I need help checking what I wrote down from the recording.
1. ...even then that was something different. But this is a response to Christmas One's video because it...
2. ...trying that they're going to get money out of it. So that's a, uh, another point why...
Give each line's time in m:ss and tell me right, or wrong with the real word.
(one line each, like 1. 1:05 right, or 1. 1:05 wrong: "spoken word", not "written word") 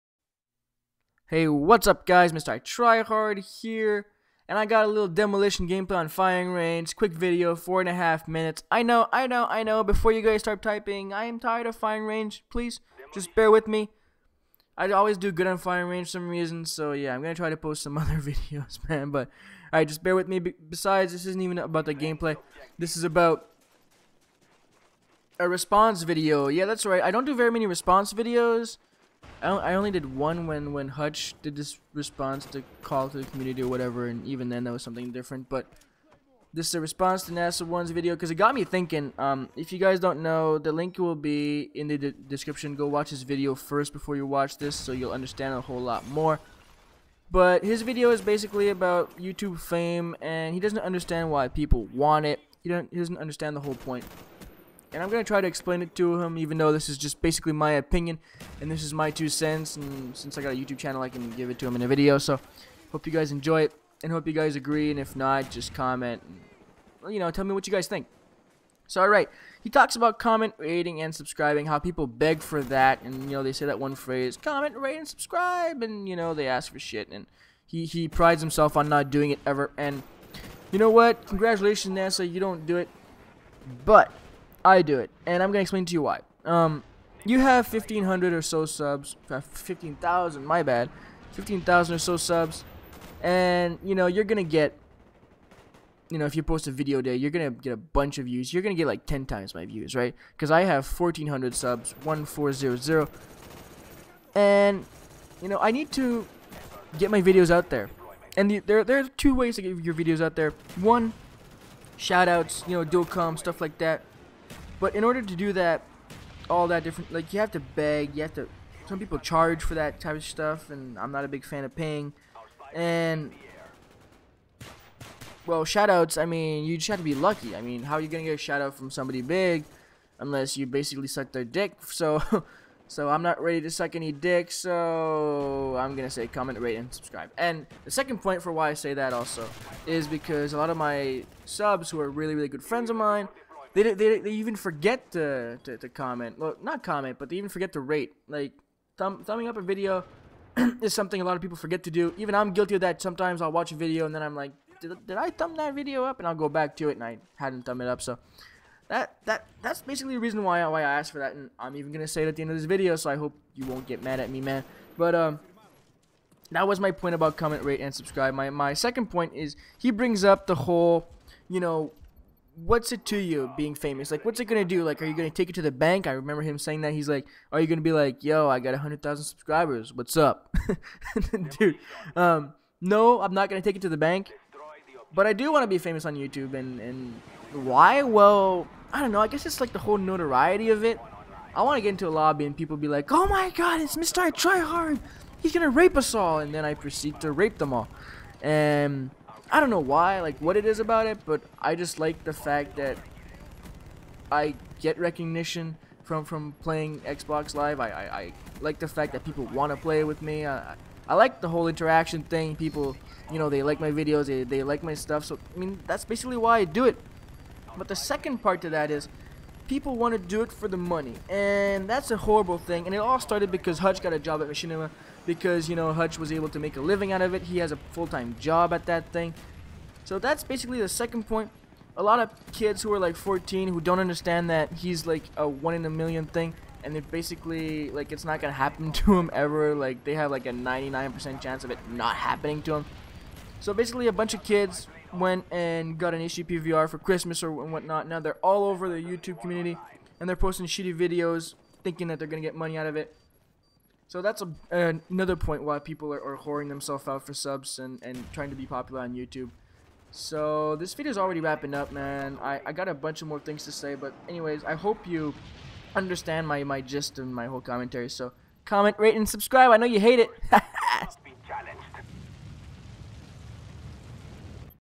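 1. 0:34 wrong: "NASA", not "Christmas"
2. 4:11 wrong: "thinking", not "trying".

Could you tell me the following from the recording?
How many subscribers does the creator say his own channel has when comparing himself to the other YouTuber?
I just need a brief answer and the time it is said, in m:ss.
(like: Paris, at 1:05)
1,400, at 1:40.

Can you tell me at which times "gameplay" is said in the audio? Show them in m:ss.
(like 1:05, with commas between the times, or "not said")
0:05, 0:21.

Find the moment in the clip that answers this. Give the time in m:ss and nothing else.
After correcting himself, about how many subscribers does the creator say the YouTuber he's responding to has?
1:29.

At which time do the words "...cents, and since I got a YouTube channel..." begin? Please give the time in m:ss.
0:59.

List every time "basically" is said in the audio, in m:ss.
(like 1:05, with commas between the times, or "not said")
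0:48, 0:57, 2:10, 2:39, 3:36, 3:50, 3:57, 4:03.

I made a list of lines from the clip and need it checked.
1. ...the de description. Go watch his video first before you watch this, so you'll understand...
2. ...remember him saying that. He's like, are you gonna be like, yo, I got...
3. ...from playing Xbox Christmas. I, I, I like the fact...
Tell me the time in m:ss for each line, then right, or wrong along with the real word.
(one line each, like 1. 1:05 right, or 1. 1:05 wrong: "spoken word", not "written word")
1. 0:41 right
2. 2:56 right
3. 3:26 wrong: "Live", not "Christmas".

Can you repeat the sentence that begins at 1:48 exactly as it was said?
And the, there, there are two ways to get your videos out there.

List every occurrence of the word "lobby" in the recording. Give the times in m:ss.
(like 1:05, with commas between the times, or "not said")
3:12.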